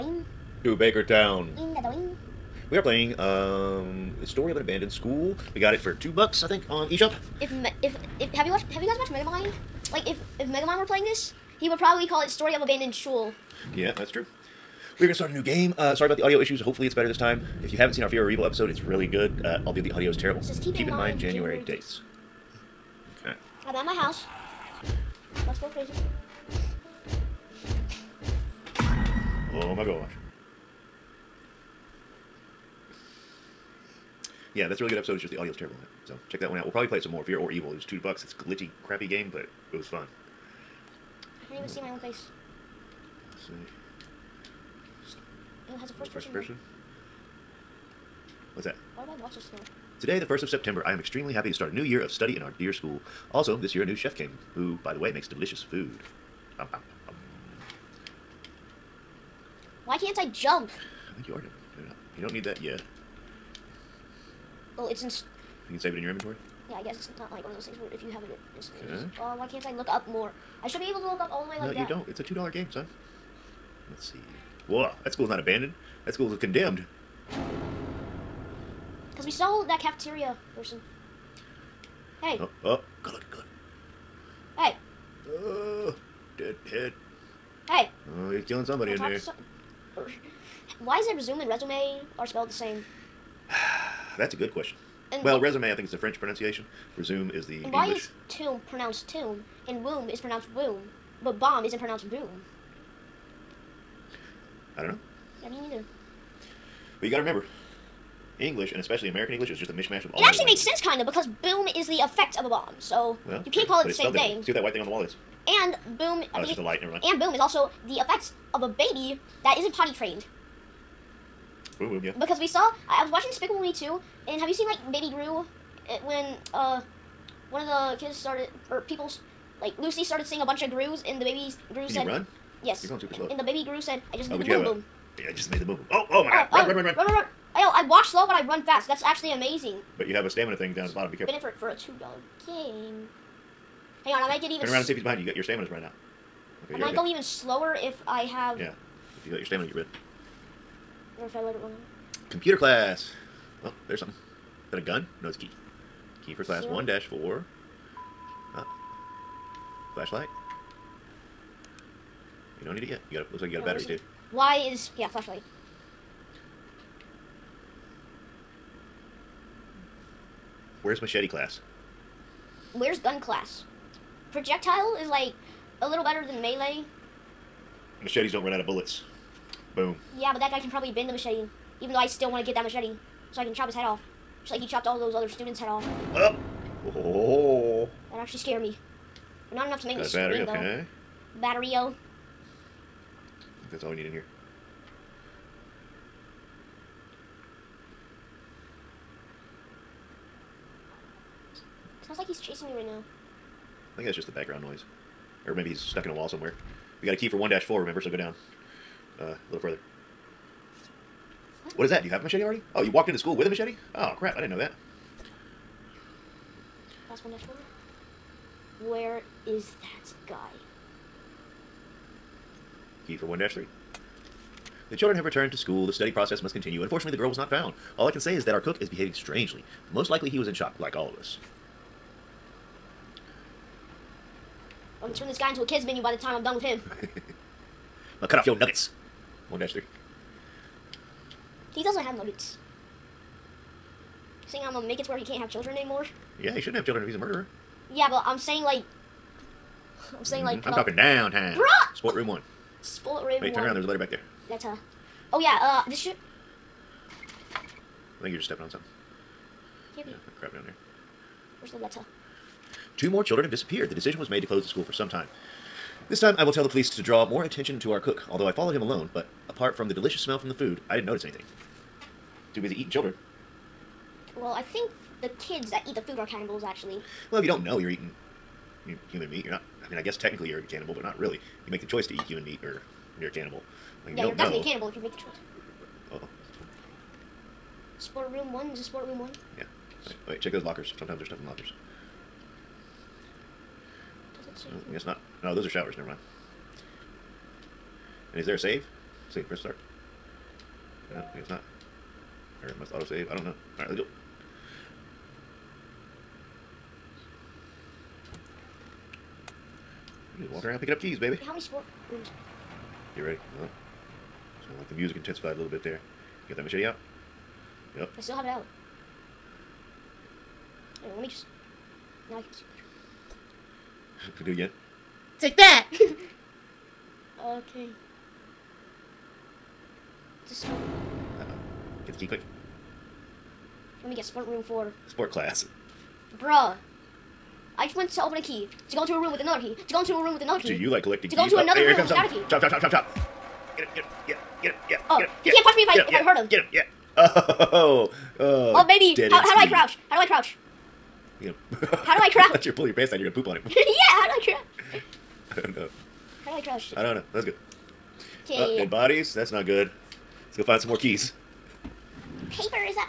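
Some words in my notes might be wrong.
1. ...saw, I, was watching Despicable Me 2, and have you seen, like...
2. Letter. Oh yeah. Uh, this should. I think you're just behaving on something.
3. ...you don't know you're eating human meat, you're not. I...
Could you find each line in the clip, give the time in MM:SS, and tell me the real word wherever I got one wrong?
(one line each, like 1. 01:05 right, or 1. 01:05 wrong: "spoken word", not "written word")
1. 02:02 right
2. 04:14 wrong: "stepping", not "behaving"
3. 04:37 right.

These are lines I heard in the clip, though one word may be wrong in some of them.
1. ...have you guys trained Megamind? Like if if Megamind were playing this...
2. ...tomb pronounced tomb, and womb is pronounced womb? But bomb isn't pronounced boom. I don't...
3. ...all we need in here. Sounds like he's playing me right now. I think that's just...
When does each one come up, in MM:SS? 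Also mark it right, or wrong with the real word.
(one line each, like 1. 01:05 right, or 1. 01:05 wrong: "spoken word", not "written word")
1. 00:08 wrong: "watched", not "trained"
2. 01:38 right
3. 03:13 wrong: "chasing", not "playing".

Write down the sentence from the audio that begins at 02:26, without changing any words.
go even slower if I have...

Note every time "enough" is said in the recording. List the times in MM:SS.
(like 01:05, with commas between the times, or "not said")
03:09.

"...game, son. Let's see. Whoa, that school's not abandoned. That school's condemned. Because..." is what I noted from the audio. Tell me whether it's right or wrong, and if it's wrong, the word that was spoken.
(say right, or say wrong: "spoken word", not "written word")
right.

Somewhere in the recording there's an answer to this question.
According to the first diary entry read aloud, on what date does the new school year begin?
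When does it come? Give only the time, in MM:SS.
00:50.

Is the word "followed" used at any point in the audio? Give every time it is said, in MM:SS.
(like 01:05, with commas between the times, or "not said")
04:28.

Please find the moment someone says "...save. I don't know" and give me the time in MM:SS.
05:03.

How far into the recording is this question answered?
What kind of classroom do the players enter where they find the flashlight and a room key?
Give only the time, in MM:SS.
02:32.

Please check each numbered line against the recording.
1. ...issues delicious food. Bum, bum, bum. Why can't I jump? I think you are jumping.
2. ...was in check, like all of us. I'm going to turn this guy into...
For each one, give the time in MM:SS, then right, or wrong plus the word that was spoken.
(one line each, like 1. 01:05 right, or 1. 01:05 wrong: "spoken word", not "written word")
1. 00:55 wrong: "makes", not "issues"
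2. 03:50 wrong: "shock", not "check".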